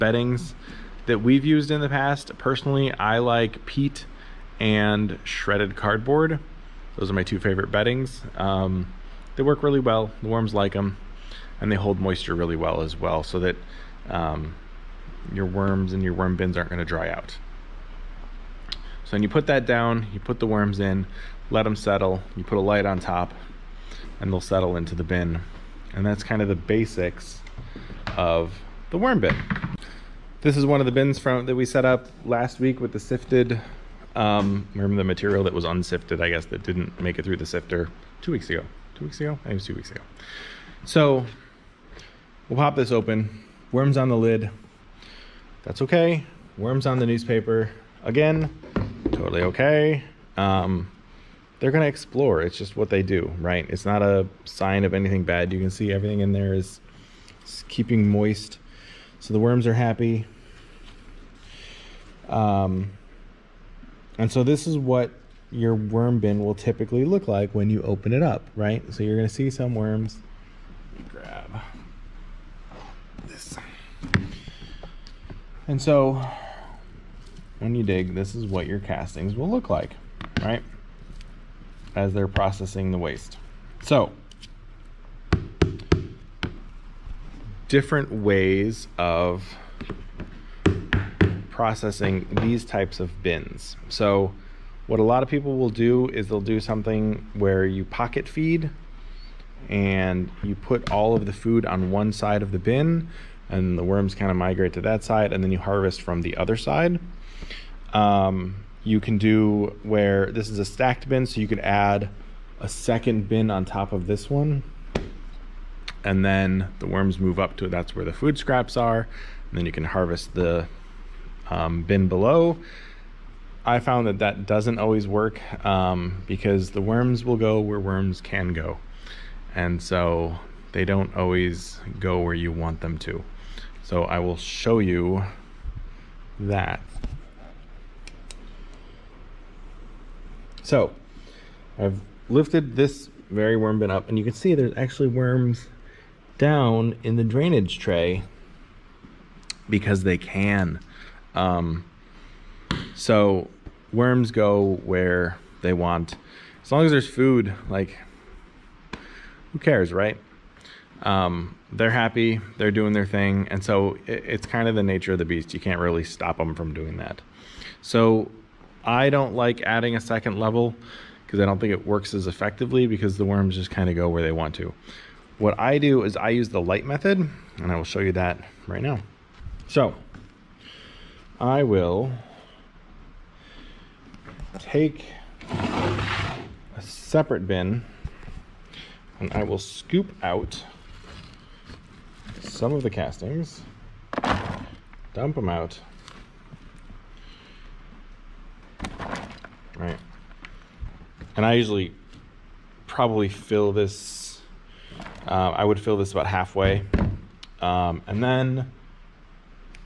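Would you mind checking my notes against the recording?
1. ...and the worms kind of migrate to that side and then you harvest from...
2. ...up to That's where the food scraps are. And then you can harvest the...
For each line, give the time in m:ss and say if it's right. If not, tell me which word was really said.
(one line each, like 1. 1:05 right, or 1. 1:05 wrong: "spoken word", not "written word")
1. 1:43 right
2. 1:57 right.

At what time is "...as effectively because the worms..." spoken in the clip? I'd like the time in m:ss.
2:52.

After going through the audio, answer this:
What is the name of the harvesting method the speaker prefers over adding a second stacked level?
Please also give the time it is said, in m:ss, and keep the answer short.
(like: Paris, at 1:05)
the light method, at 2:56.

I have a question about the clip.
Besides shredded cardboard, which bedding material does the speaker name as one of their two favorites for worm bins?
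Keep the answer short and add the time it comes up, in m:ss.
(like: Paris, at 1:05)
peat, at 0:03.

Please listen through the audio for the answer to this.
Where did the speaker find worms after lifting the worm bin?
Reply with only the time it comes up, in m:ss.
2:27.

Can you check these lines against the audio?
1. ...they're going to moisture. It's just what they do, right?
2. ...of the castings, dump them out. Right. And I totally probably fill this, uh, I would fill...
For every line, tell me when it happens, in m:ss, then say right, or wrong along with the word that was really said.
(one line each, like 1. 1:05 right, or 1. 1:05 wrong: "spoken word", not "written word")
1. 0:51 wrong: "explore", not "moisture"
2. 3:12 wrong: "usually", not "totally".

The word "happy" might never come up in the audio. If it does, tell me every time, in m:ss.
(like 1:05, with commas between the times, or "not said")
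0:59, 2:41.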